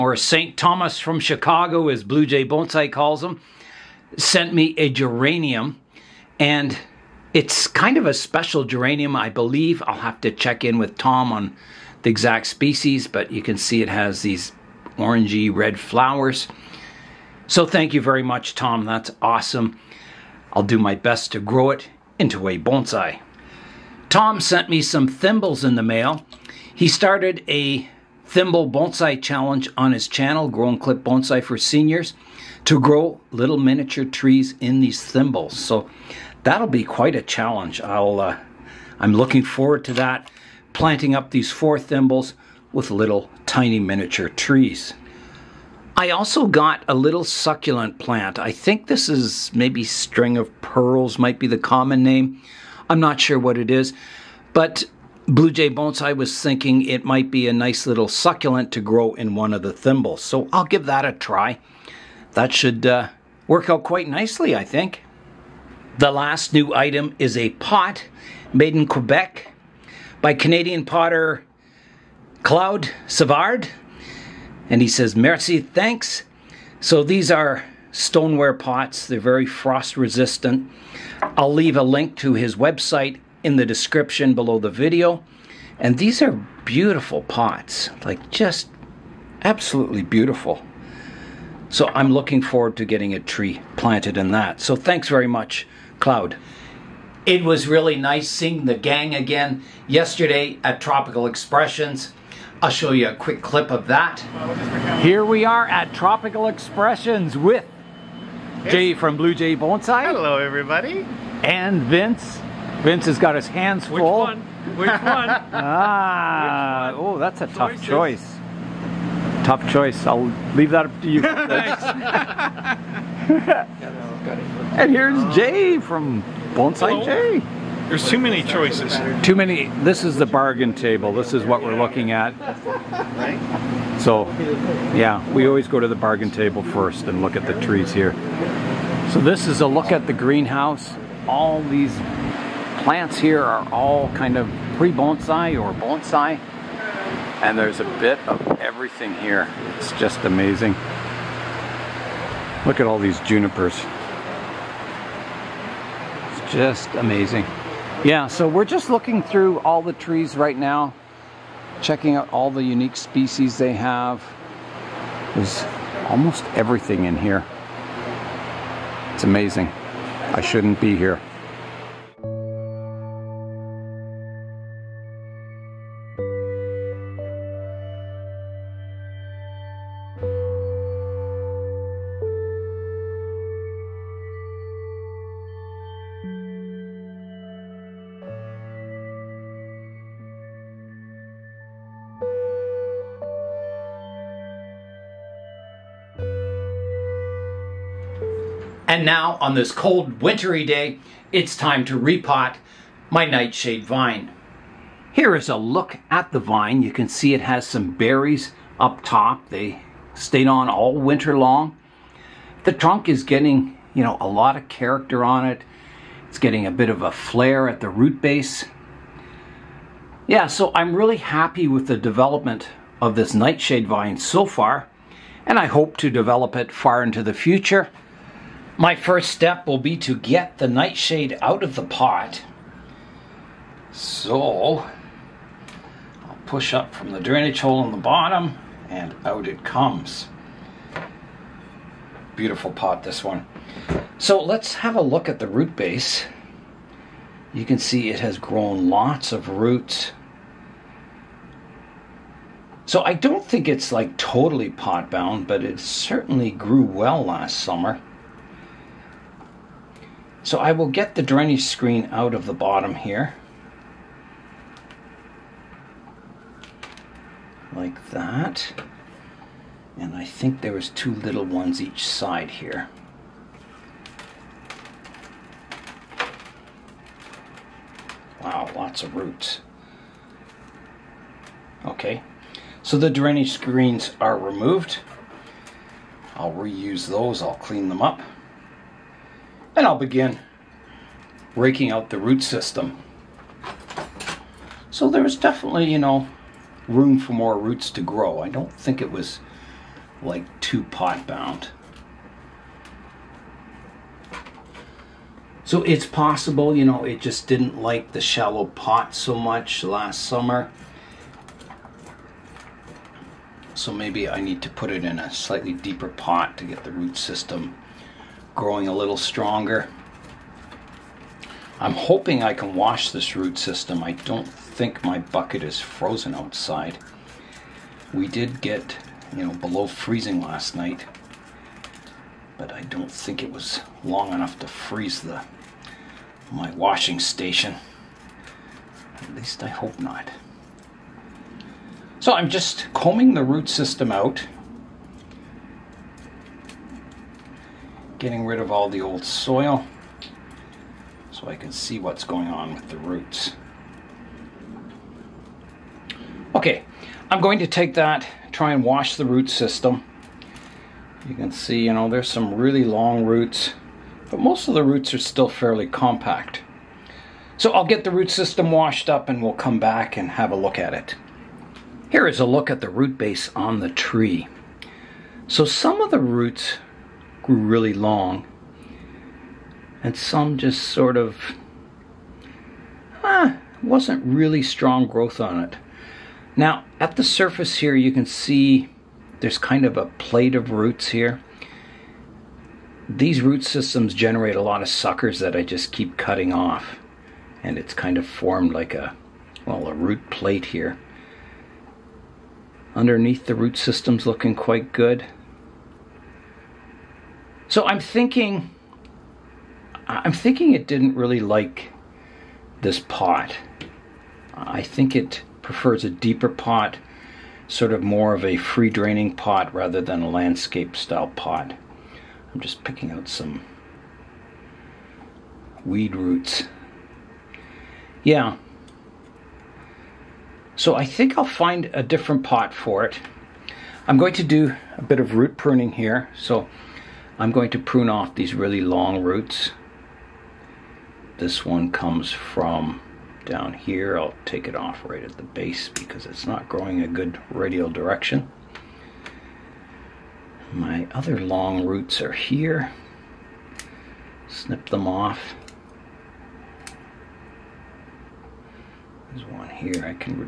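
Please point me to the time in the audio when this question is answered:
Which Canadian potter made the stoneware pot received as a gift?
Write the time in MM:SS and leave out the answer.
01:12.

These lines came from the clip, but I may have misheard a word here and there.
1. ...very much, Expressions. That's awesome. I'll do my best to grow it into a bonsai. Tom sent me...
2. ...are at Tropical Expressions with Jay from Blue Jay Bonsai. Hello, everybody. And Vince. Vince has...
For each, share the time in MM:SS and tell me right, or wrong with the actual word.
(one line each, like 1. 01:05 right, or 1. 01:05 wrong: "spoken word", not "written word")
1. 00:18 wrong: "Tom", not "Expressions"
2. 01:45 right.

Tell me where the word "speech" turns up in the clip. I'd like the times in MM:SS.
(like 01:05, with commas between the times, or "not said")
not said.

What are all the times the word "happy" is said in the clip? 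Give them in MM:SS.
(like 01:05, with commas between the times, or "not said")
03:41.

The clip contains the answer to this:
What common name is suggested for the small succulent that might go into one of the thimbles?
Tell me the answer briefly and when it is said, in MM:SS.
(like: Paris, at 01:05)
string of pearls, at 00:49.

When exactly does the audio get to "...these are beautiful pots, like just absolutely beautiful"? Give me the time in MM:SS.
01:25.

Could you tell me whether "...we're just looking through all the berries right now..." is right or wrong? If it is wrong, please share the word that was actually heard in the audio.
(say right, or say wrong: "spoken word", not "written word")
wrong: "trees", not "berries".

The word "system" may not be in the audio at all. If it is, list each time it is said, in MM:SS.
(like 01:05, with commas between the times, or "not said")
04:52, 05:17, 05:23, 05:43, 05:59, 06:08, 06:33, 06:43.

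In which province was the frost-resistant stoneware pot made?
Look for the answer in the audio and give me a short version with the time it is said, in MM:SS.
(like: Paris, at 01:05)
Quebec, at 01:08.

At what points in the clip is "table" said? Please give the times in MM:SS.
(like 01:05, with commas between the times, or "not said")
02:10, 02:16.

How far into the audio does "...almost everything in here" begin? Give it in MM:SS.
02:46.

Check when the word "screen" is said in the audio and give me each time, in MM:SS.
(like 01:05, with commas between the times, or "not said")
04:21, 04:43.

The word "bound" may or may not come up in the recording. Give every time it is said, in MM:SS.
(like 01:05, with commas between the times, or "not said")
04:15, 05:01.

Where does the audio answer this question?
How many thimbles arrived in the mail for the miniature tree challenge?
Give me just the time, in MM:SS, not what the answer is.
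00:41.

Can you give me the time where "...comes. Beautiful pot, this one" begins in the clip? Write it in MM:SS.
03:59.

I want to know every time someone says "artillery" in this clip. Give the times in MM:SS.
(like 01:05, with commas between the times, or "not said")
not said.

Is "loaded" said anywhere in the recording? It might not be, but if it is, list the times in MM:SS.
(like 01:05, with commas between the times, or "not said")
not said.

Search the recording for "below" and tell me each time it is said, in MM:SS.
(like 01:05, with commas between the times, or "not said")
01:24, 05:29.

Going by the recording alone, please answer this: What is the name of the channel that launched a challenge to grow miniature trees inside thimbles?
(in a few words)
Grow and Clip Bonsai for Seniors.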